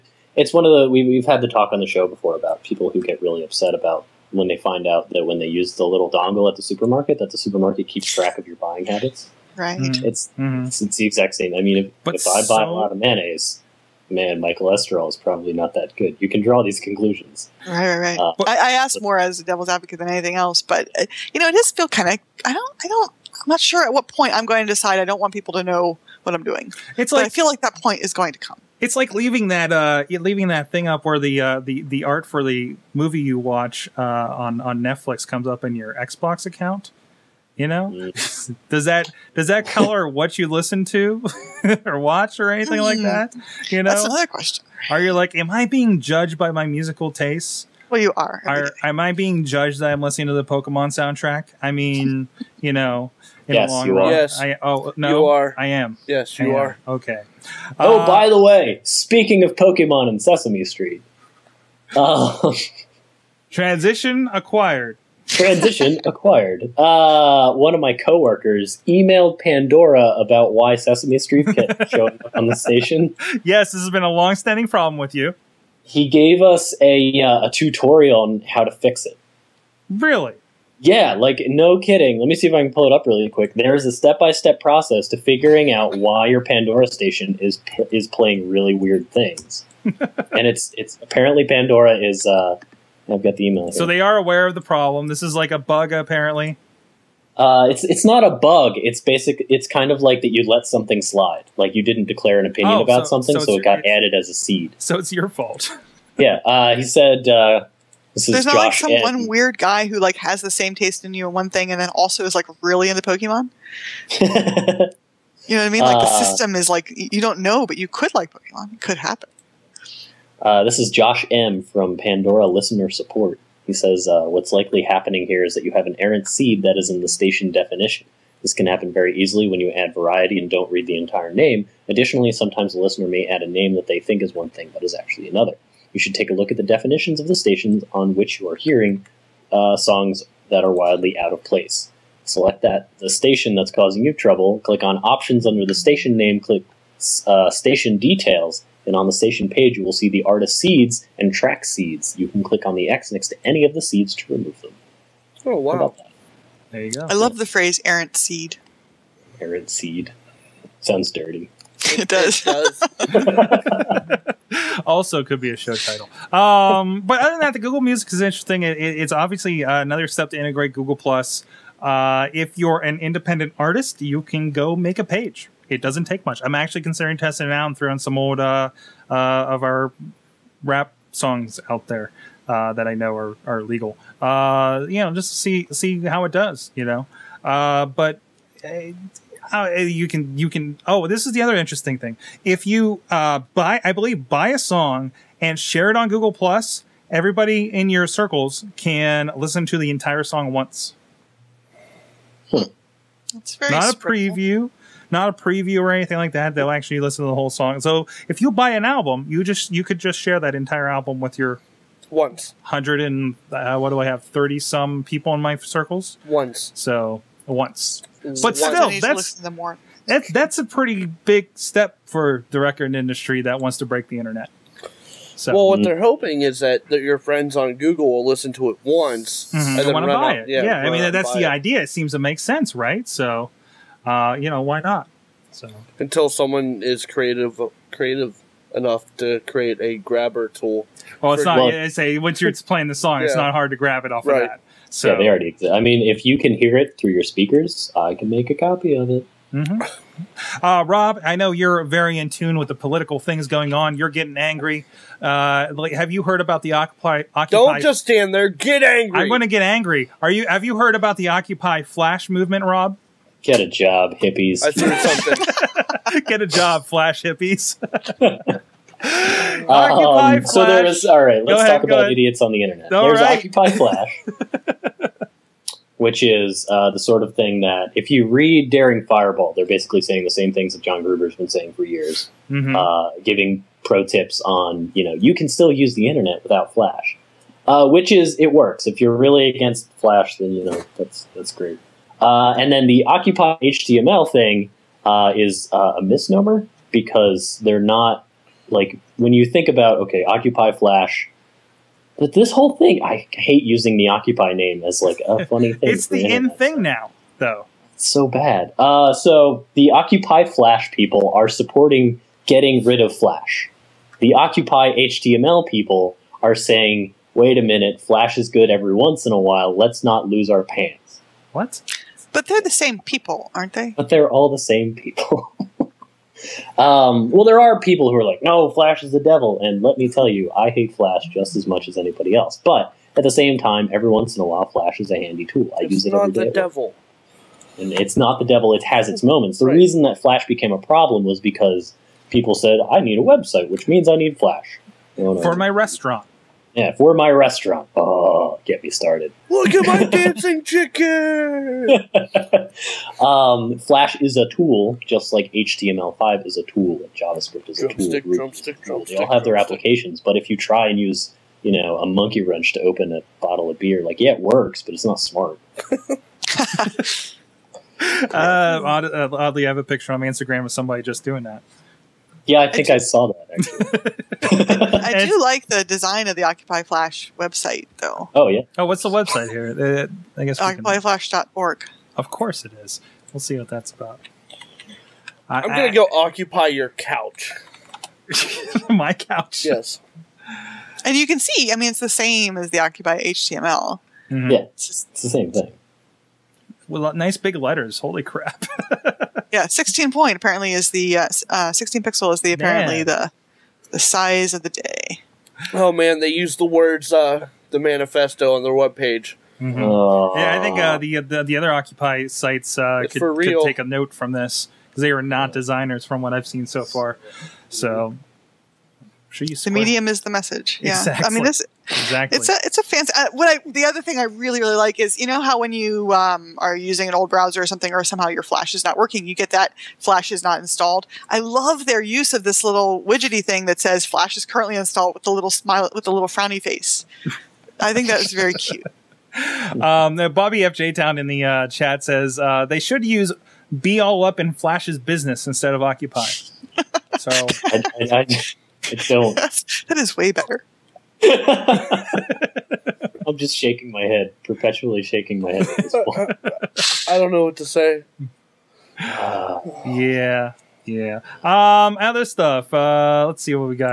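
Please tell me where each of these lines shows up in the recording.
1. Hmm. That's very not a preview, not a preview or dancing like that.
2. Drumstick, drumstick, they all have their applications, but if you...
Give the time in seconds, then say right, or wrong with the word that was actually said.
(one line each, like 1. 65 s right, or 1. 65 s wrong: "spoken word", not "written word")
1. 202 s wrong: "anything", not "dancing"
2. 358 s right.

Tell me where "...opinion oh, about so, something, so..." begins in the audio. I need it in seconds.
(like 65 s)
102 s.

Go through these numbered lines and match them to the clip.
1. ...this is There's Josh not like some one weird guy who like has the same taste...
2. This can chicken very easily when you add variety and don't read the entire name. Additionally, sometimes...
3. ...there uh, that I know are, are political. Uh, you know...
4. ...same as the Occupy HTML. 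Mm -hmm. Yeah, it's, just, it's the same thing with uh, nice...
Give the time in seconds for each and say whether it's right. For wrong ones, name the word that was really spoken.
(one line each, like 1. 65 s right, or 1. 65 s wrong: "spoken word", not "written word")
1. 108 s right
2. 128 s wrong: "happen", not "chicken"
3. 181 s wrong: "legal", not "political"
4. 392 s right.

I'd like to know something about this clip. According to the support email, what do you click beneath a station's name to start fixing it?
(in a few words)
Options.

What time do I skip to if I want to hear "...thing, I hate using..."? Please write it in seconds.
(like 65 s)
302 s.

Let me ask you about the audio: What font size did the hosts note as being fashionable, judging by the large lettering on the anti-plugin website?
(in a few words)
16 pixels.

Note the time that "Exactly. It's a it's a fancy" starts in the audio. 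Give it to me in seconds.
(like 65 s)
421 s.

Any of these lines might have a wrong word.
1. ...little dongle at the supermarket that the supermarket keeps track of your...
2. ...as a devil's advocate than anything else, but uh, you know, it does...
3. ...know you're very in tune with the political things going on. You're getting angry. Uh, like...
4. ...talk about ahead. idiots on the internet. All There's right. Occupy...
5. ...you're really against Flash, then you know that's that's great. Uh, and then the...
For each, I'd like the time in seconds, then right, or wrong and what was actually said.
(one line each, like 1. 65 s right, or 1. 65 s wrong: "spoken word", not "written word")
1. 5 s right
2. 19 s right
3. 251 s right
4. 271 s right
5. 288 s right.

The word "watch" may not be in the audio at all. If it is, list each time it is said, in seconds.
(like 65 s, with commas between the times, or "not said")
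33 s, 41 s.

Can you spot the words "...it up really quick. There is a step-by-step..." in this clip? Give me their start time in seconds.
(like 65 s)
82 s.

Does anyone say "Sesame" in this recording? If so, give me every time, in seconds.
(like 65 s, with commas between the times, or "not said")
60 s, 70 s.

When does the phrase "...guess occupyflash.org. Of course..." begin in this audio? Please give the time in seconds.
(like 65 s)
380 s.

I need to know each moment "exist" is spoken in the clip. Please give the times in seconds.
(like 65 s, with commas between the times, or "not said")
245 s.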